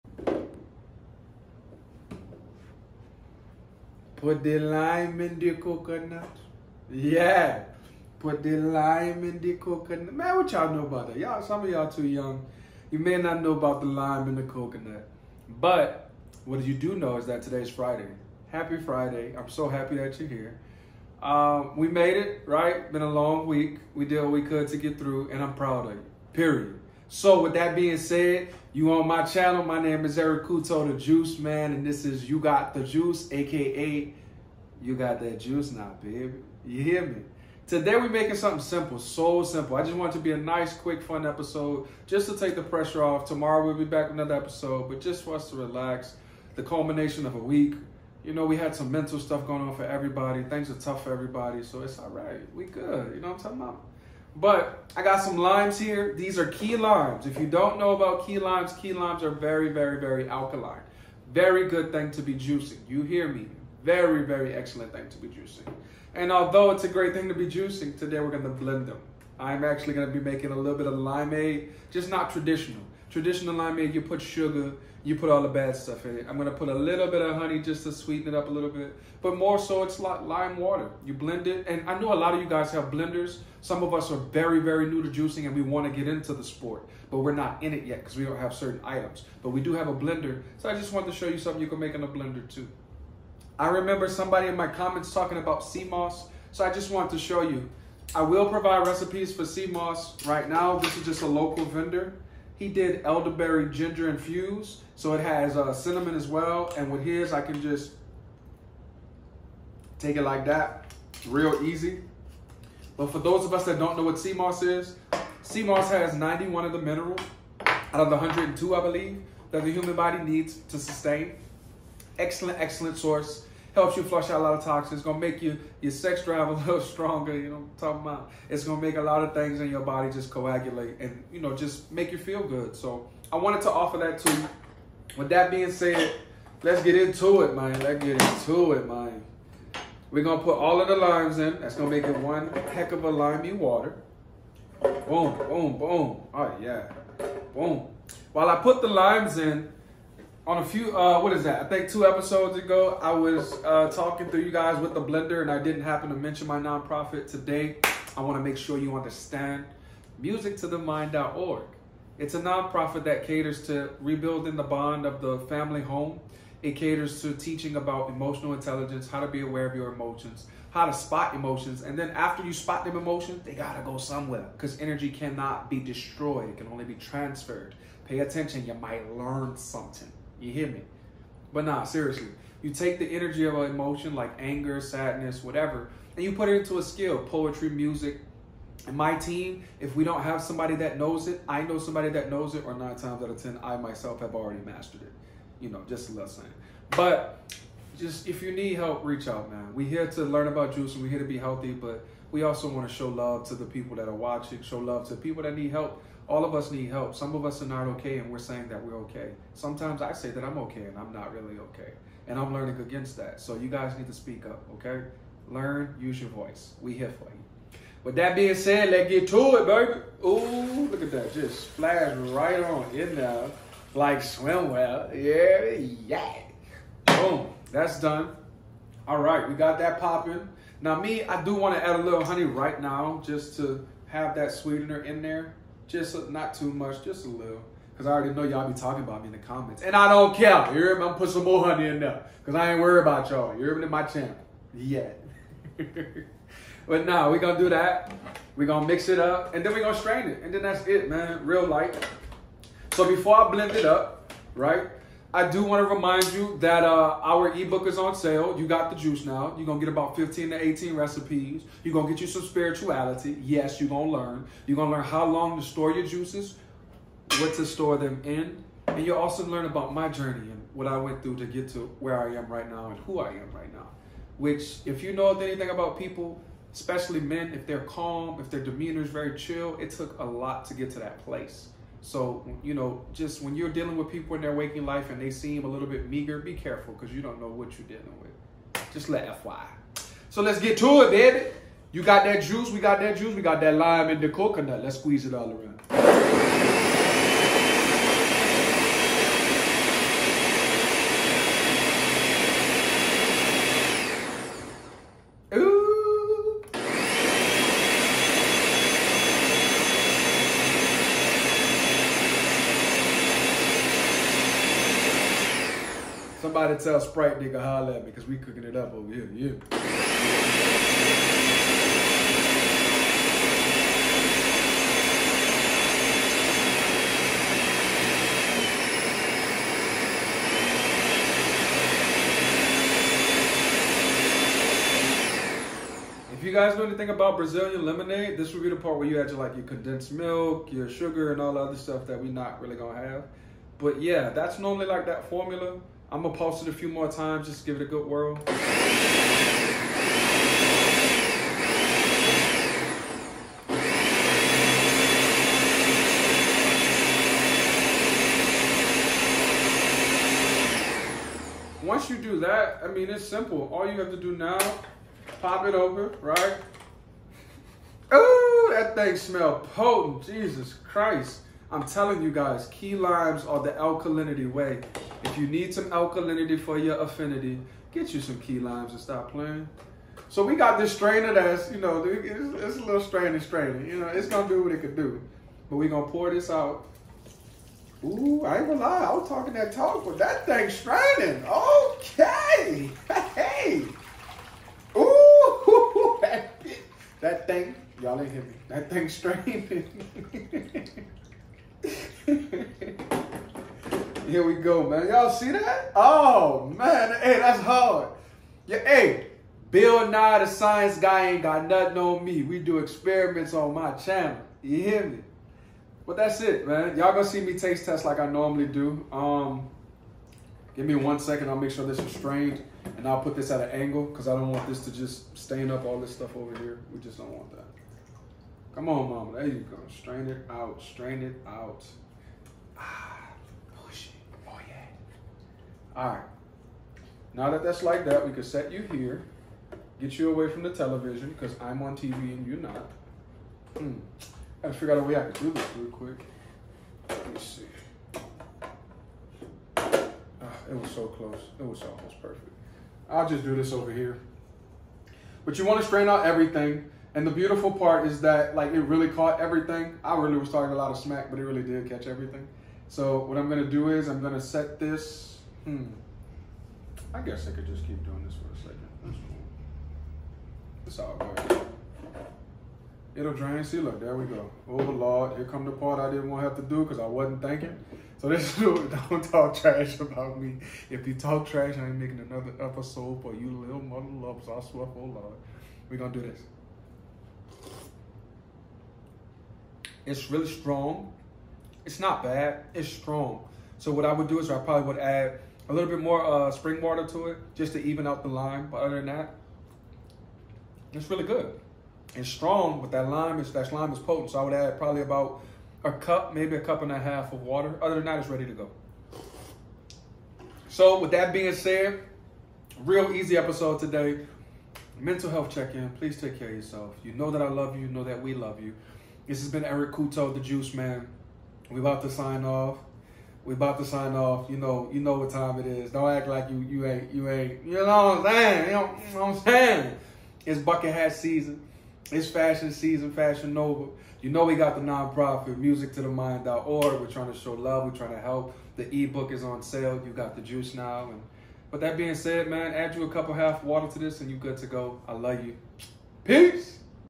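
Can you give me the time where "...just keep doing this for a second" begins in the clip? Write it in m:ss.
7:47.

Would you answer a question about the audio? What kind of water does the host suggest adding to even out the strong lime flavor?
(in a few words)
Spring water.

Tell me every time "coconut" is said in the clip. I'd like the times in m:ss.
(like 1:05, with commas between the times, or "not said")
0:05, 0:09, 0:14, 4:54.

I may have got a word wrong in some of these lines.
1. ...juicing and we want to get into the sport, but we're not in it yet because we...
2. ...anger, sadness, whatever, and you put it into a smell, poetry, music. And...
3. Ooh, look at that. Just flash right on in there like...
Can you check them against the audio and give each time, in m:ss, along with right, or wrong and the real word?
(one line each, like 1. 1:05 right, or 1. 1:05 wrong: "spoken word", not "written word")
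1. 1:25 right
2. 3:04 wrong: "skill", not "smell"
3. 3:40 right.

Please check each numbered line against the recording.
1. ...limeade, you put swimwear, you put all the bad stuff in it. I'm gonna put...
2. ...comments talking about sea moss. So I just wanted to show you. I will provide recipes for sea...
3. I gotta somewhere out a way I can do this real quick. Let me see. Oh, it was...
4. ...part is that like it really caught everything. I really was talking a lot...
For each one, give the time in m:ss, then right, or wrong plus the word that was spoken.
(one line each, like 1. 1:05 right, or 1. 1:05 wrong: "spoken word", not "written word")
1. 1:13 wrong: "sugar", not "swimwear"
2. 1:34 right
3. 7:24 wrong: "figure", not "somewhere"
4. 7:37 right.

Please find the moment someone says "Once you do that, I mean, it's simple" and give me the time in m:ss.
6:01.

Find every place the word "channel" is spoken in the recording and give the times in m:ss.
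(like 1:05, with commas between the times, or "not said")
0:29, 4:04, 6:53.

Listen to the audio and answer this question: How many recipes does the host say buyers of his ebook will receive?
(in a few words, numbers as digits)
15 to 18.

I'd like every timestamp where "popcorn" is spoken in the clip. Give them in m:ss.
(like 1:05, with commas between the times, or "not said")
not said.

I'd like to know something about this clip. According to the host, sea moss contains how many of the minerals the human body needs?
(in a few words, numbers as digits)
91.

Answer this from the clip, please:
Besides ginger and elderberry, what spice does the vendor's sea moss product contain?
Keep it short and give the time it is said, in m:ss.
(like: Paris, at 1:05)
Cinnamon, at 1:45.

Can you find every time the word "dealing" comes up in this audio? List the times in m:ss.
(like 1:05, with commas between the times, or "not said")
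4:43, 4:47.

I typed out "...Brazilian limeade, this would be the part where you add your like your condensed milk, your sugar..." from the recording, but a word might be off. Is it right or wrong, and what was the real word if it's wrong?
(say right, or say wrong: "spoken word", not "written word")
wrong: "lemonade", not "limeade".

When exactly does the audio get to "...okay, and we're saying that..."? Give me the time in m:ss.
3:27.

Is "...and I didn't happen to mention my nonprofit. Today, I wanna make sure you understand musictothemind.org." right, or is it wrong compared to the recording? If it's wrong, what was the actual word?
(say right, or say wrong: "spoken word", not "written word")
right.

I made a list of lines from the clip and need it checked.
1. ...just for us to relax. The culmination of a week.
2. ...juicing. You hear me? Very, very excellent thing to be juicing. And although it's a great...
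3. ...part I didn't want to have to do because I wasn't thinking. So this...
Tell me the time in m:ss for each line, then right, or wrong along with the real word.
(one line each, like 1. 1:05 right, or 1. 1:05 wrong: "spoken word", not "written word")
1. 0:45 right
2. 1:02 right
3. 7:55 right.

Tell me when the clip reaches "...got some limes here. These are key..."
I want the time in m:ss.
0:55.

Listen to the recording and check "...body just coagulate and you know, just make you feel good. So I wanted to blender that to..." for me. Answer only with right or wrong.
wrong.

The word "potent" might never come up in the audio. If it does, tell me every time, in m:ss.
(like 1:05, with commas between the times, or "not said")
6:09, 8:23.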